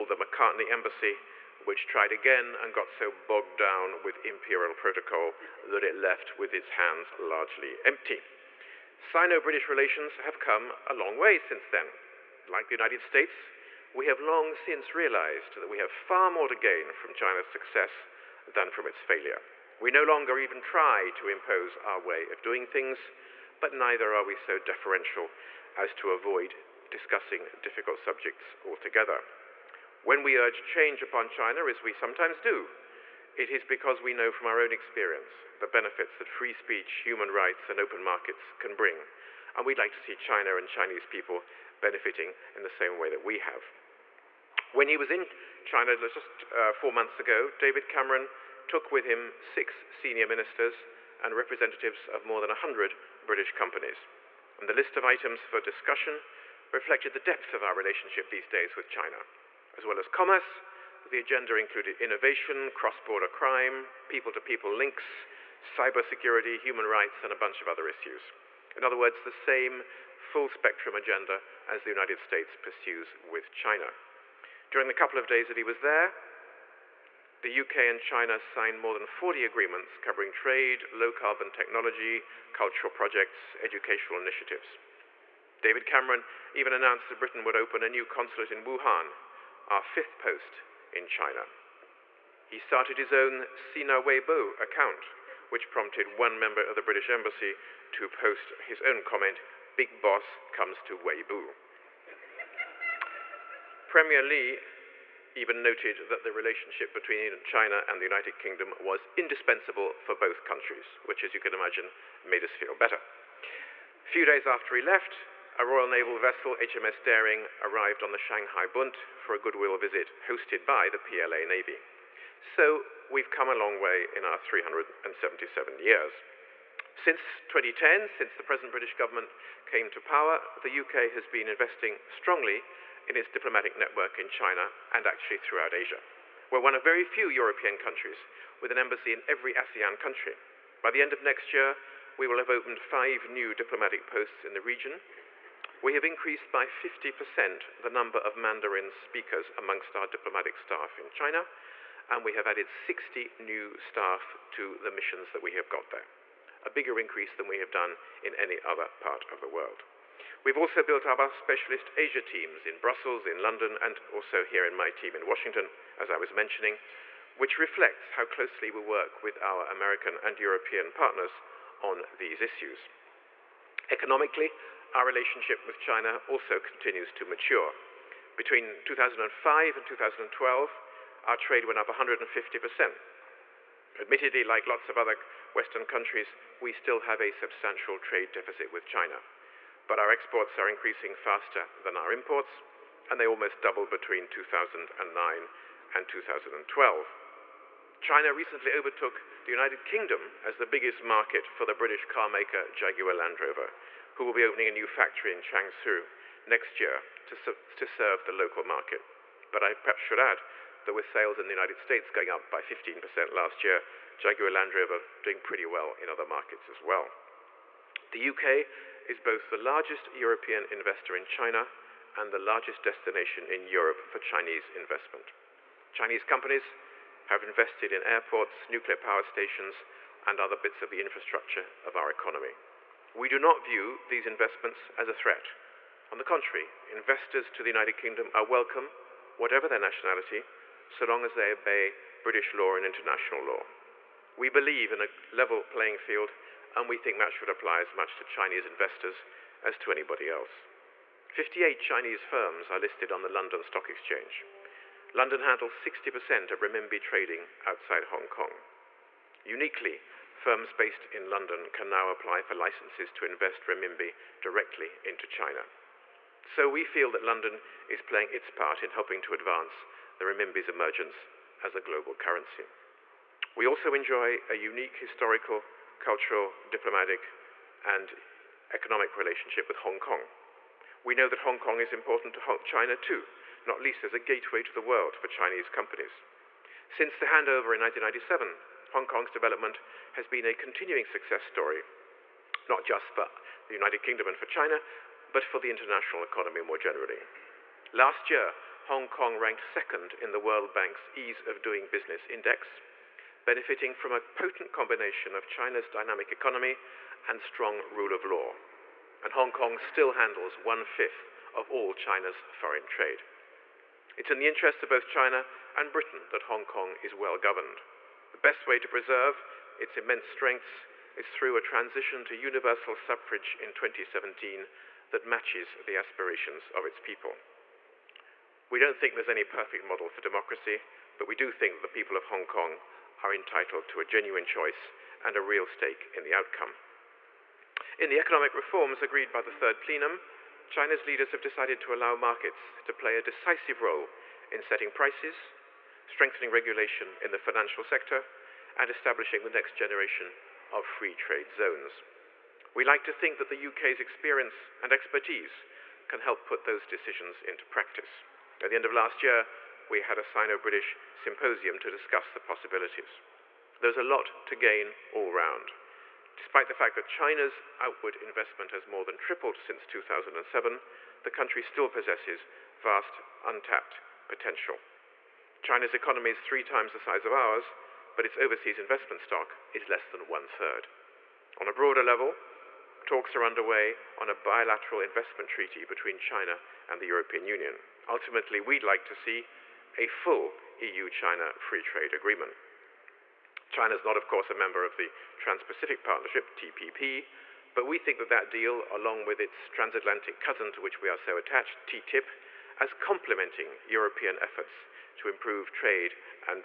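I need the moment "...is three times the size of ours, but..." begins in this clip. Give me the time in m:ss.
6:16.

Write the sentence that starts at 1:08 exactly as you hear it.
In other words, the same full spectrum agenda as the United States pursues with China.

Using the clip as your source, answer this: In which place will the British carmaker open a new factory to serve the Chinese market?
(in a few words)
Changshu.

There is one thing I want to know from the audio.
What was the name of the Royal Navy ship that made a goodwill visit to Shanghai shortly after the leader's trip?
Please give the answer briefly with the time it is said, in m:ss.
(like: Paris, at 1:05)
HMS Daring, at 1:56.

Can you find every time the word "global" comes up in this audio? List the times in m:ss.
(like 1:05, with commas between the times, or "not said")
4:31.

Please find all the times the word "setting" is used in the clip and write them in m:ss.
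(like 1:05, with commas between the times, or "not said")
5:44.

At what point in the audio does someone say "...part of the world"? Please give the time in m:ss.
2:39.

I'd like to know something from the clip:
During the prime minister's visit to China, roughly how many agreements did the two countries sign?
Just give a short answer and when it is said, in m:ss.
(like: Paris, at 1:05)
more than 40, at 1:18.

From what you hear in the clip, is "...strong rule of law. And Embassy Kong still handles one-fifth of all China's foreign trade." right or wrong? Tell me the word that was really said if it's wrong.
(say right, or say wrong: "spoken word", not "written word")
wrong: "Hong", not "Embassy".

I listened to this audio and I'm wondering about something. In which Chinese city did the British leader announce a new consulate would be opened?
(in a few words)
Wuhan.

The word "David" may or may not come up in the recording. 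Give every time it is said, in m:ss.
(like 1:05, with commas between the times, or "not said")
0:47, 1:25.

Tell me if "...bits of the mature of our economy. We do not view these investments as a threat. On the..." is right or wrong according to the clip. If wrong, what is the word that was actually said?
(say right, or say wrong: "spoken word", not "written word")
wrong: "infrastructure", not "mature".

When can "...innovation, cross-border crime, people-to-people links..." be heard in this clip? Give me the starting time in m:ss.
1:02.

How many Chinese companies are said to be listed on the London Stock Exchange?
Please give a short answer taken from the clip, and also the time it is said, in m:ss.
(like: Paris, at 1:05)
58, at 4:11.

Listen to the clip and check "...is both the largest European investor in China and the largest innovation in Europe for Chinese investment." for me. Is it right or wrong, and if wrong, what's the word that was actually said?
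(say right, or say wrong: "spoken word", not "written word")
wrong: "destination", not "innovation".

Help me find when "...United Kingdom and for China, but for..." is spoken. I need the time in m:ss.
4:53.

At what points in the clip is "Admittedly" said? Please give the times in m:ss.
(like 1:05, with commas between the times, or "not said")
3:03.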